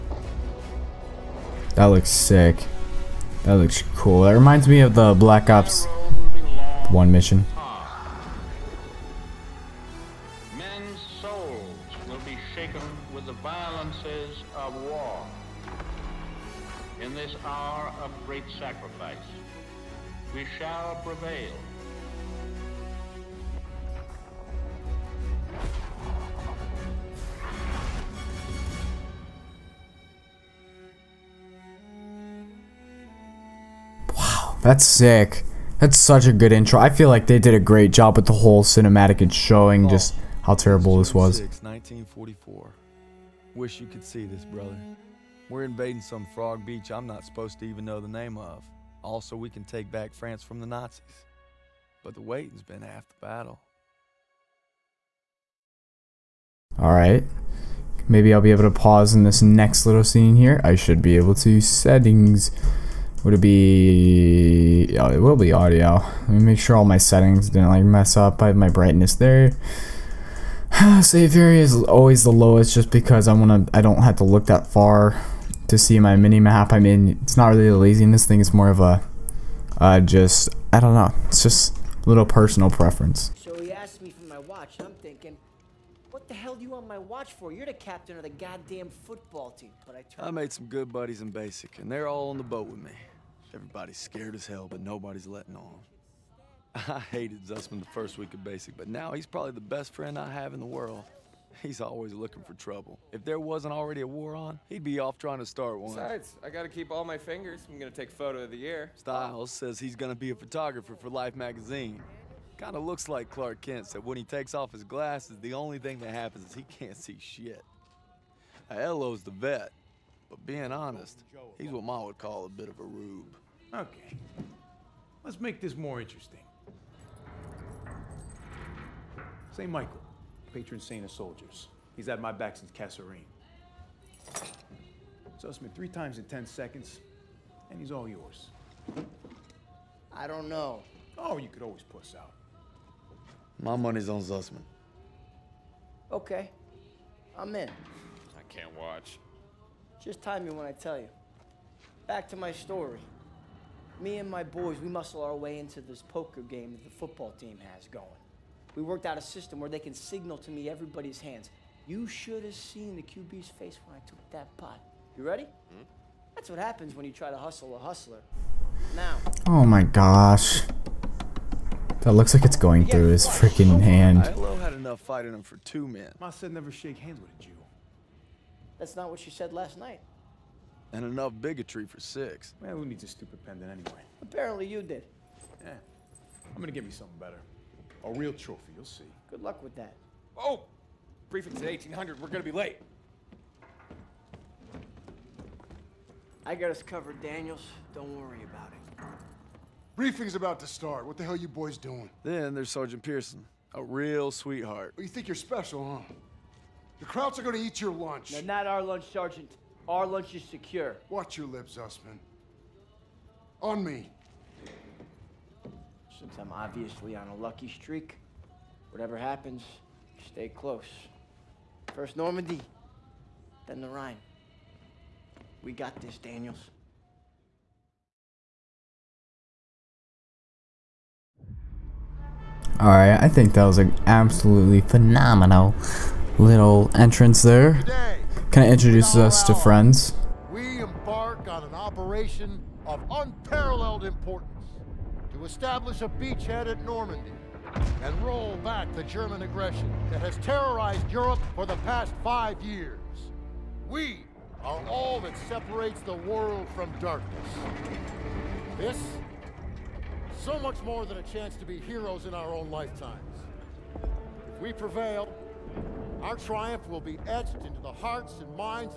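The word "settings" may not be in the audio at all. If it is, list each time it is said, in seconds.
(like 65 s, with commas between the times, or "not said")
61 s, 66 s.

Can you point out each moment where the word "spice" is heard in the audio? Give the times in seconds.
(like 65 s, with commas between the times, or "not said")
not said.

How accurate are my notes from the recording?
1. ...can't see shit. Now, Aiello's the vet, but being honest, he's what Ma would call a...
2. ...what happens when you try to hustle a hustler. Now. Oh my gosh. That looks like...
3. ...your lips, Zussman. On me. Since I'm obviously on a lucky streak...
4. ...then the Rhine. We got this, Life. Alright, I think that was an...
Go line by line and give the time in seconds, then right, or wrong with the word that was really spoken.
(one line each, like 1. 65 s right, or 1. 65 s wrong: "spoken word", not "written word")
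1. 116 s right
2. 166 s right
3. 211 s right
4. 223 s wrong: "Daniels", not "Life".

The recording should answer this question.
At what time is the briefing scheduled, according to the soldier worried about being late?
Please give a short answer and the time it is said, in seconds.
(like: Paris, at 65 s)
1800, at 191 s.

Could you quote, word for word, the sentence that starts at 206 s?
The Krauts are gonna eat your lunch.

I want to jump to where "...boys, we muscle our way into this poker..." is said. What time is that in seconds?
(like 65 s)
154 s.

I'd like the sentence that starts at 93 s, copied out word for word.
Everybody's scared as hell, but nobody's letting on.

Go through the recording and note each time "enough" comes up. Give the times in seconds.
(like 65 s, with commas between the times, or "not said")
174 s, 181 s.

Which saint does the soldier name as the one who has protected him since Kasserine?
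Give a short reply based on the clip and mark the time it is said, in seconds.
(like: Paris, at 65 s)
St. Michael, at 129 s.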